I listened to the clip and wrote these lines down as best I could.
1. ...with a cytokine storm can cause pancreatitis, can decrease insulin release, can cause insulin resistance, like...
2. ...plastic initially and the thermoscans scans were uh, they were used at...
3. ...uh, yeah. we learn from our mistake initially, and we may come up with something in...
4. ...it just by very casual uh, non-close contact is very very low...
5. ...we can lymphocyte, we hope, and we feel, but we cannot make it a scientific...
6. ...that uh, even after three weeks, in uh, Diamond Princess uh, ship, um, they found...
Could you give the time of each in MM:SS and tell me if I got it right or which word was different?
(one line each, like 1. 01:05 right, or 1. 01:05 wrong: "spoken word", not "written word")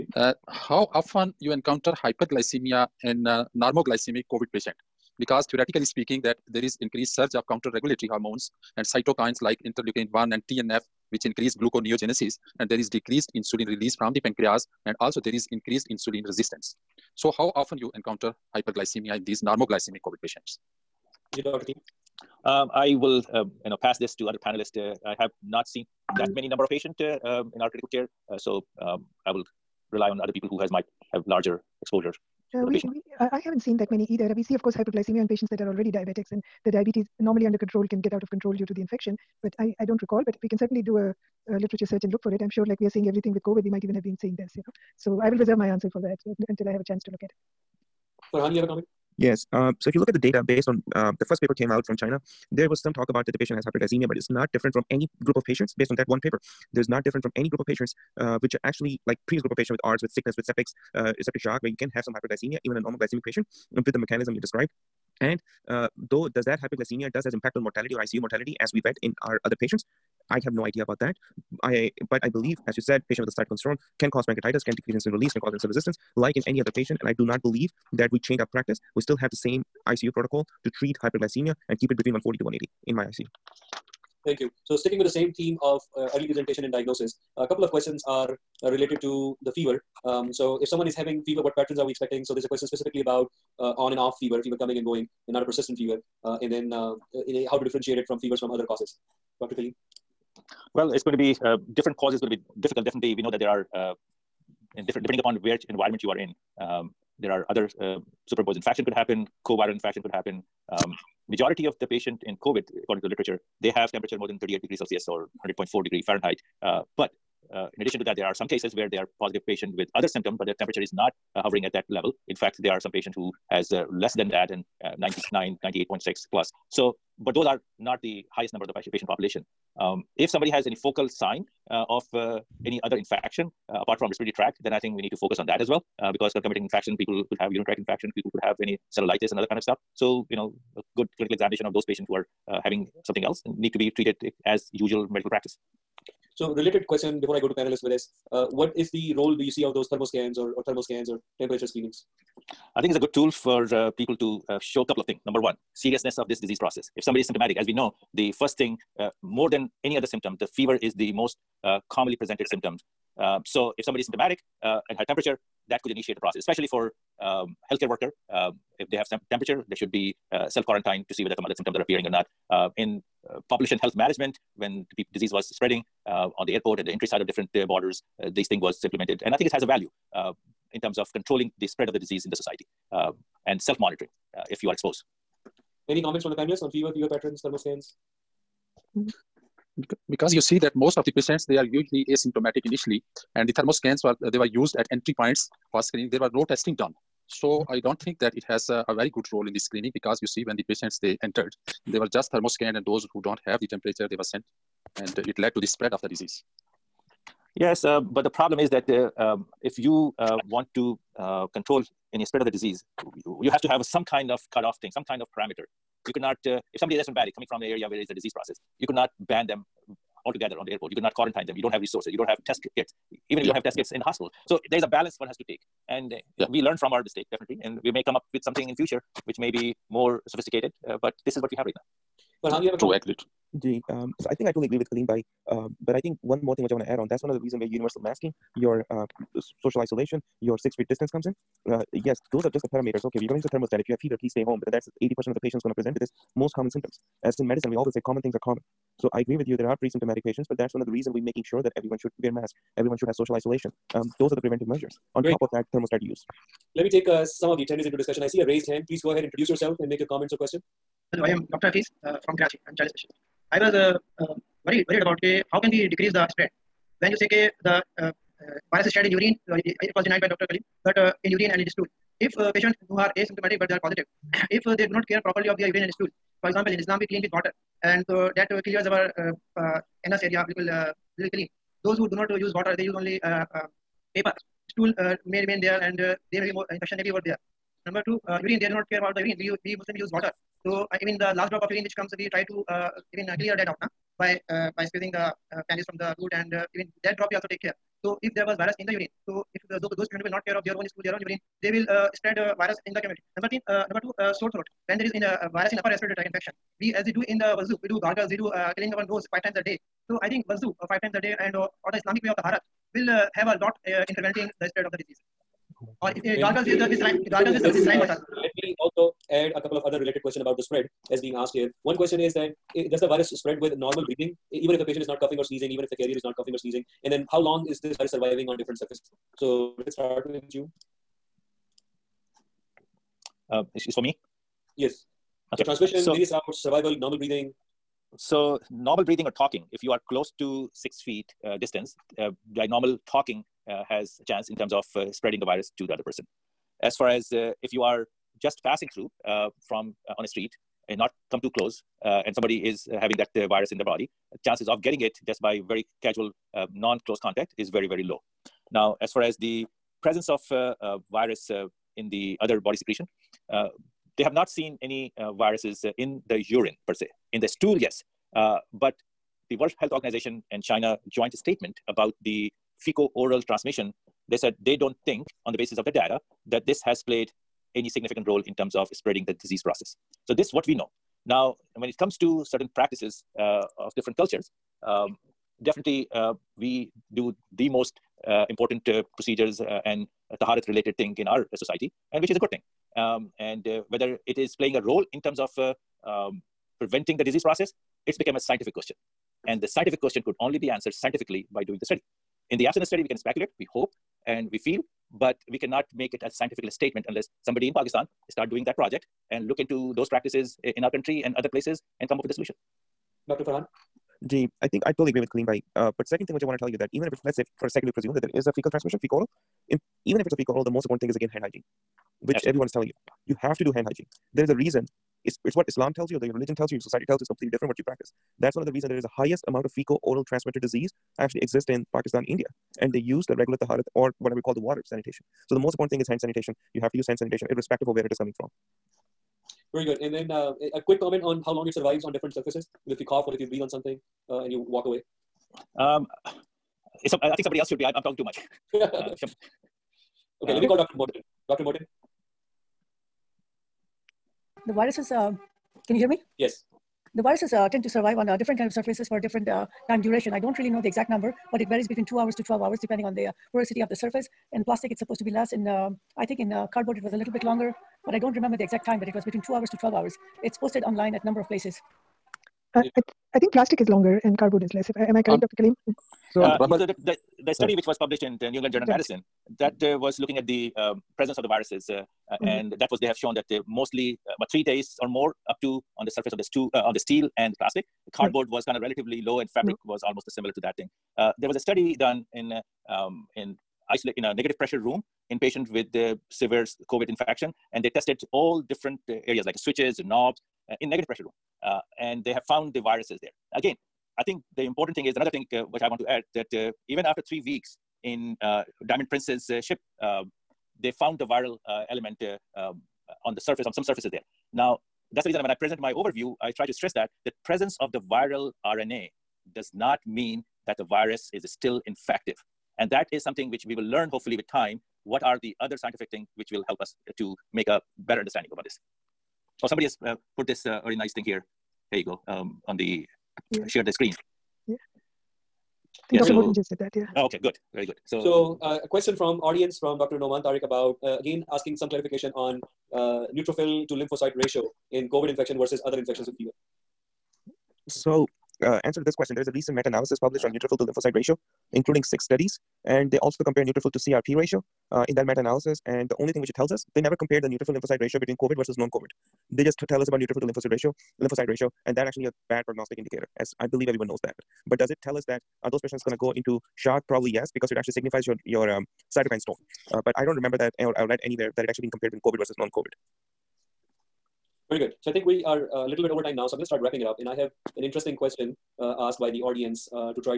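1. 01:13 right
2. 03:12 wrong: "asymptomatic", not "plastic"
3. 03:46 wrong: "definitely", not "initially"
4. 05:55 right
5. 06:43 wrong: "speculate", not "lymphocyte"
6. 08:26 right.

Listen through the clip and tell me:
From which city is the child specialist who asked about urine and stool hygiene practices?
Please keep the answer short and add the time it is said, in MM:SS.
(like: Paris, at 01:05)
Karachi, at 04:22.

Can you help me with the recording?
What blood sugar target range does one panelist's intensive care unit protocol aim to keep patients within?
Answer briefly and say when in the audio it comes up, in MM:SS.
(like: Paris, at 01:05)
140 to 180, at 01:22.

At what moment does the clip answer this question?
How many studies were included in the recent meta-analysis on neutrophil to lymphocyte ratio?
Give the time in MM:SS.
09:12.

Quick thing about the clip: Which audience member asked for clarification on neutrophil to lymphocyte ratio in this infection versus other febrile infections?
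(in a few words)
Dr. Noman Tariq.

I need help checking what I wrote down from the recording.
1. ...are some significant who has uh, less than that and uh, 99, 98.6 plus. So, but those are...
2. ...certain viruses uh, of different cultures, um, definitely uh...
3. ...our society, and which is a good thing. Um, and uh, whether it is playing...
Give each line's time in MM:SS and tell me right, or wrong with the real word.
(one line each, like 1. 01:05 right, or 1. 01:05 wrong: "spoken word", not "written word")
1. 02:02 wrong: "patient", not "significant"
2. 06:22 wrong: "practices", not "viruses"
3. 06:31 right.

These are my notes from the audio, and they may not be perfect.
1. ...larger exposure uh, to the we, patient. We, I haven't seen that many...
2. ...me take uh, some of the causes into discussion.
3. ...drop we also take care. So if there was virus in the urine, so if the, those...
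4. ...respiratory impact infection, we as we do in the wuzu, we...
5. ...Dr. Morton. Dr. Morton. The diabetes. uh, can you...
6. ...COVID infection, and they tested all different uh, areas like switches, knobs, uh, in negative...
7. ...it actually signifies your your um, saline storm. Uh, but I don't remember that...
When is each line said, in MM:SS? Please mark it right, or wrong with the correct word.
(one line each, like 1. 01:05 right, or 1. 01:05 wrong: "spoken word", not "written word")
1. 00:31 right
2. 04:16 wrong: "attendees", not "causes"
3. 04:57 right
4. 05:05 wrong: "tract", not "impact"
5. 07:30 wrong: "viruses", not "diabetes"
6. 08:16 right
7. 09:27 wrong: "cytokine", not "saline".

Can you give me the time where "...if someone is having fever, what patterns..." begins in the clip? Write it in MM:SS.
01:30.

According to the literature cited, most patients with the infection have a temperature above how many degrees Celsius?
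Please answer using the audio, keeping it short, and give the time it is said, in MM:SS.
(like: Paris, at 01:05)
38, at 01:54.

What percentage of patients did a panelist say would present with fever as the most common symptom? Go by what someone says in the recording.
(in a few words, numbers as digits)
80%.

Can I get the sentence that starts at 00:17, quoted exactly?
So how often you encounter hyperglycemia in these normoglycemic COVID patients?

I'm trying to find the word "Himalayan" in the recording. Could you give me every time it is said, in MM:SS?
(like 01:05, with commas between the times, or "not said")
not said.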